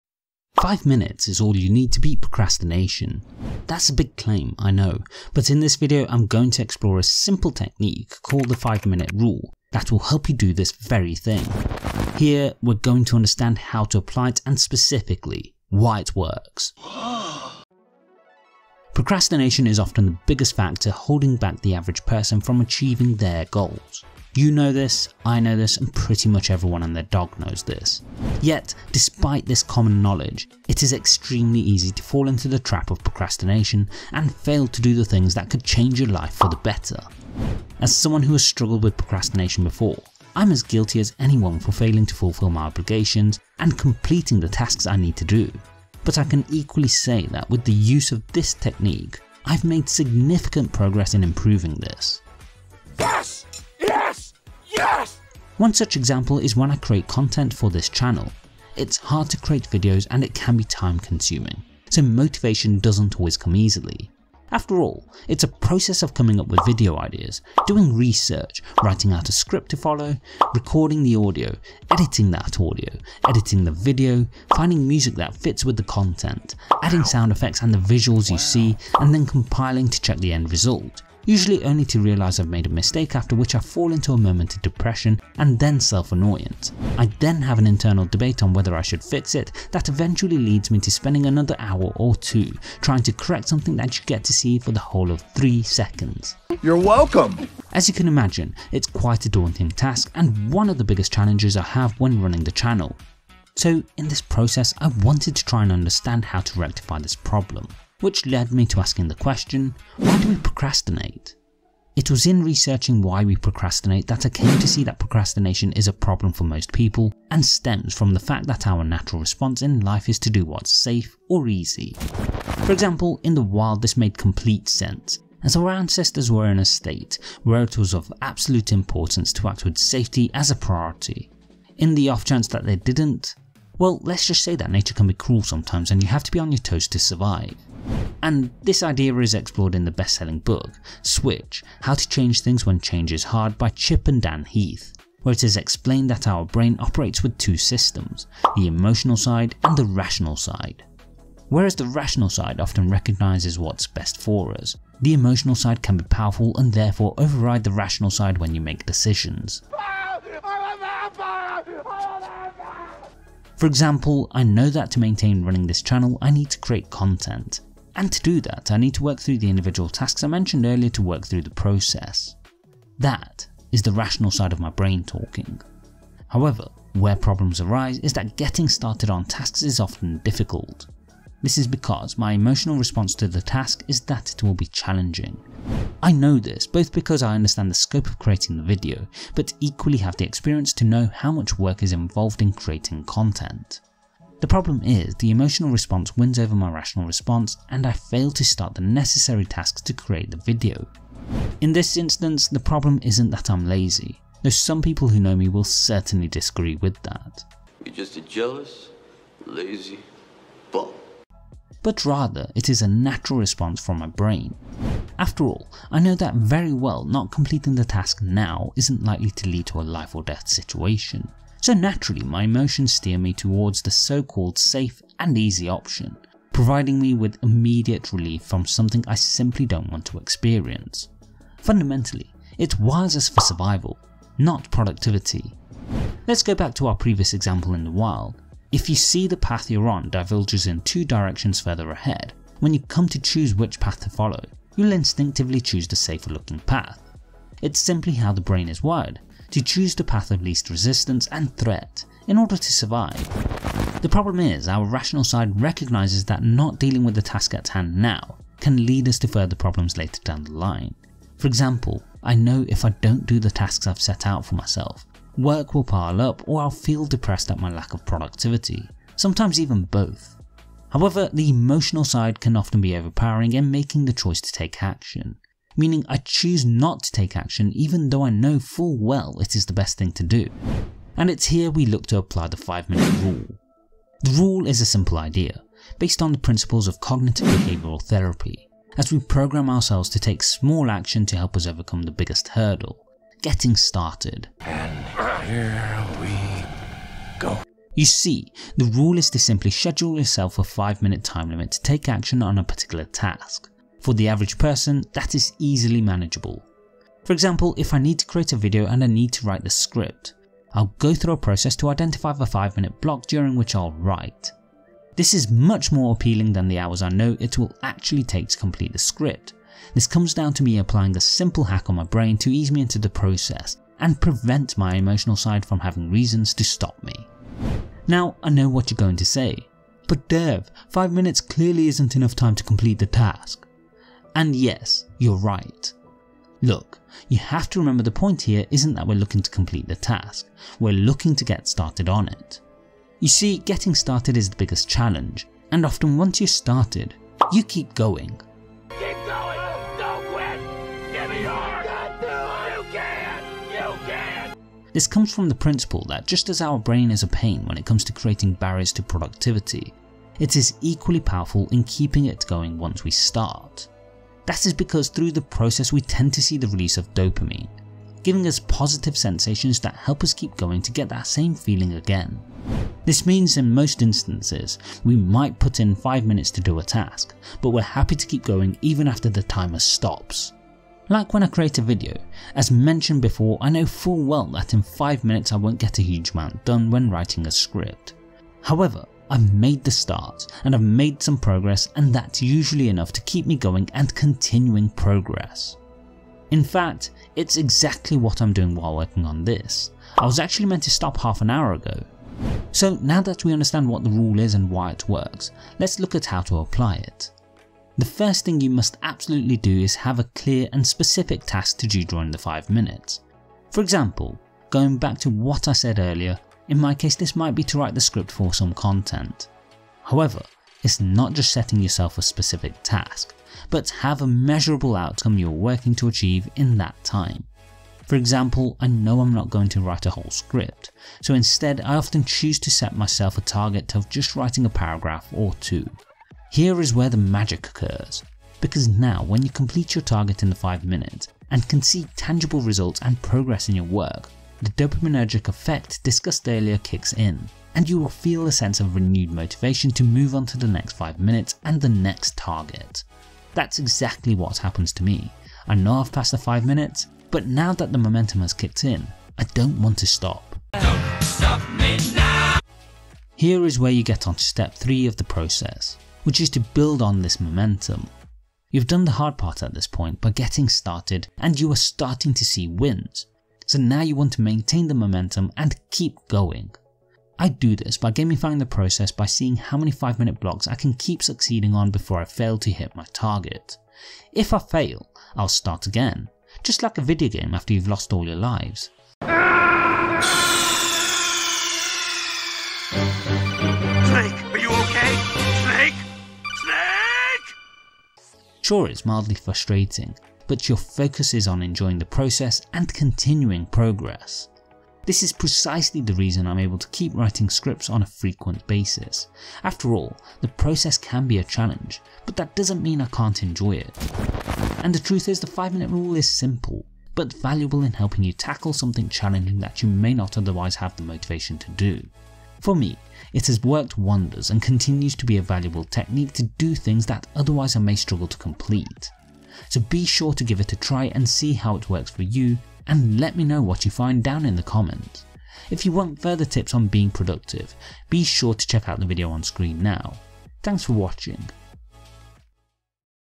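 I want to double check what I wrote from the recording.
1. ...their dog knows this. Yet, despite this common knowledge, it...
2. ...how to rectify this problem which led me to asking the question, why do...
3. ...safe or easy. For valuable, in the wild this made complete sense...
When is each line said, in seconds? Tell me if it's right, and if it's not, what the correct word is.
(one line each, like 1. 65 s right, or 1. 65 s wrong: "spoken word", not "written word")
1. 26 s right
2. 106 s right
3. 120 s wrong: "example", not "valuable".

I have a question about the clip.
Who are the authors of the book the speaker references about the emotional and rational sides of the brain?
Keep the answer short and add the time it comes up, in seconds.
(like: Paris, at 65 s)
Chip and Dan Heath, at 143 s.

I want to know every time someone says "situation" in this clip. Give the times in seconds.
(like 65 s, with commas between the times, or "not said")
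220 s.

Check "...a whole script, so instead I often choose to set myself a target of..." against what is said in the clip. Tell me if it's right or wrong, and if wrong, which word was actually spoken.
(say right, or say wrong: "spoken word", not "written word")
right.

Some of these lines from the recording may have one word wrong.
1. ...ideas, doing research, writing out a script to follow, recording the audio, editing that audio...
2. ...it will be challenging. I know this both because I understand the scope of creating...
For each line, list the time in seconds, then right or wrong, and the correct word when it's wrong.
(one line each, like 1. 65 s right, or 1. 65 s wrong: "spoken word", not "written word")
1. 66 s right
2. 184 s right.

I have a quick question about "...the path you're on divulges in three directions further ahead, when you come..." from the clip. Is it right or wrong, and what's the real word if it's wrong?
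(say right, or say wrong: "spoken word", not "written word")
wrong: "two", not "three".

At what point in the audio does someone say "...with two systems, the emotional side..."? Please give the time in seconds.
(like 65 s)
147 s.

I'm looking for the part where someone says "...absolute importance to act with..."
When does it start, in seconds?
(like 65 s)
128 s.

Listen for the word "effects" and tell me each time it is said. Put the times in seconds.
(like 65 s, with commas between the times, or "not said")
77 s, 445 s.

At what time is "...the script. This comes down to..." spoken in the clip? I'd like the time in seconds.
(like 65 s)
318 s.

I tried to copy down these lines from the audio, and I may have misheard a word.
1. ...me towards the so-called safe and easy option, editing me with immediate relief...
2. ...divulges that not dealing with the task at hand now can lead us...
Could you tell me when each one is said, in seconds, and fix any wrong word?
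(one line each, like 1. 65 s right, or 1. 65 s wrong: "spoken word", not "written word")
1. 223 s wrong: "providing", not "editing"
2. 255 s wrong: "recognises", not "divulges".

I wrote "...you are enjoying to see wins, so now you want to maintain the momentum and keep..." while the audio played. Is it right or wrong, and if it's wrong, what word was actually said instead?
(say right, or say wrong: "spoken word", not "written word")
wrong: "starting", not "enjoying".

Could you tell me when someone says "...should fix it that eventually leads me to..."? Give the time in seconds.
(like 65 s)
88 s.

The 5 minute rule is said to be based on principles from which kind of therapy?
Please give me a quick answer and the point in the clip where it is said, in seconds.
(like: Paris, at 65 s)
cognitive behavioural therapy, at 286 s.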